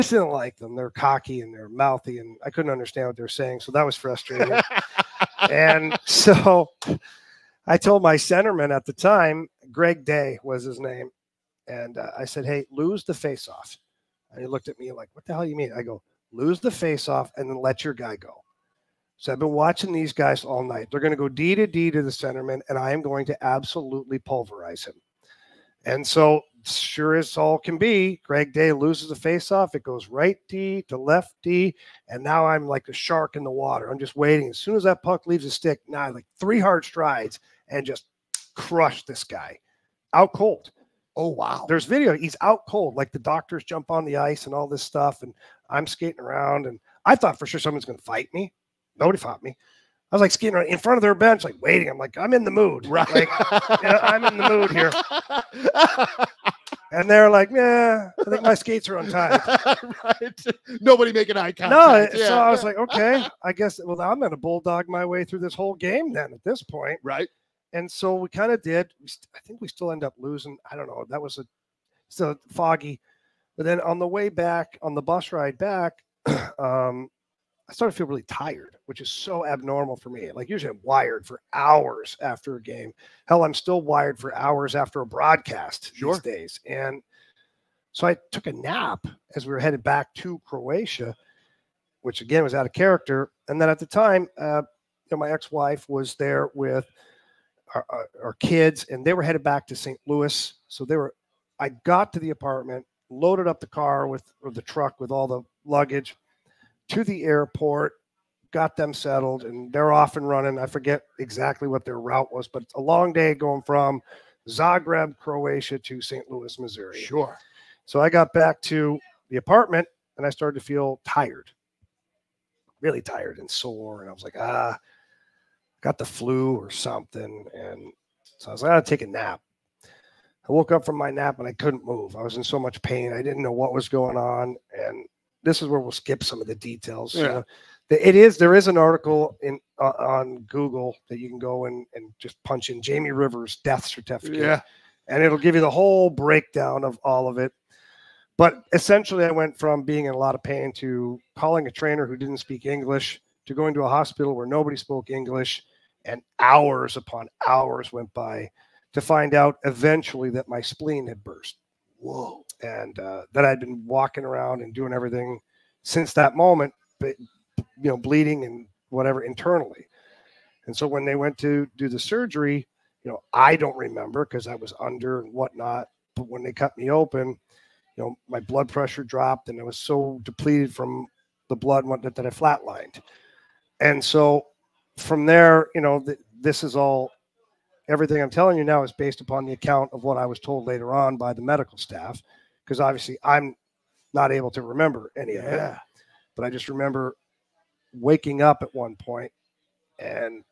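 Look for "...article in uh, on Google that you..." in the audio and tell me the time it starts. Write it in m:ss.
2:18.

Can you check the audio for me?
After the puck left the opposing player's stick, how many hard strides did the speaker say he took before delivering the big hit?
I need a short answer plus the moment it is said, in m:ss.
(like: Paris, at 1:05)
3, at 0:36.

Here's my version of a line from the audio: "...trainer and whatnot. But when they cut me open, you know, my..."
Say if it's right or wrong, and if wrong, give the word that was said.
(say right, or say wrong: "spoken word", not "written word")
wrong: "under", not "trainer".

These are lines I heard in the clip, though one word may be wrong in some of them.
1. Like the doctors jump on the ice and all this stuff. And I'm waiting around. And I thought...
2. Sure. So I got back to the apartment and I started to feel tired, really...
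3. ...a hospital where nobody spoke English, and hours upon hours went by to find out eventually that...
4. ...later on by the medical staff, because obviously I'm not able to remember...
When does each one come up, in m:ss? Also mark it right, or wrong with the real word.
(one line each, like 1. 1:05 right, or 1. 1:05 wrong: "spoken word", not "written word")
1. 0:42 wrong: "skating", not "waiting"
2. 1:56 right
3. 2:33 right
4. 3:10 right.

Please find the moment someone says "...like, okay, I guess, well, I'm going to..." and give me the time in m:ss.
1:02.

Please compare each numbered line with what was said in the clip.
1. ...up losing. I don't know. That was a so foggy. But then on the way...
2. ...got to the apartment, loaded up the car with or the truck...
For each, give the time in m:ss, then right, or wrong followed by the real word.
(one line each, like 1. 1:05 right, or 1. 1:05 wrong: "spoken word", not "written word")
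1. 1:10 right
2. 1:41 right.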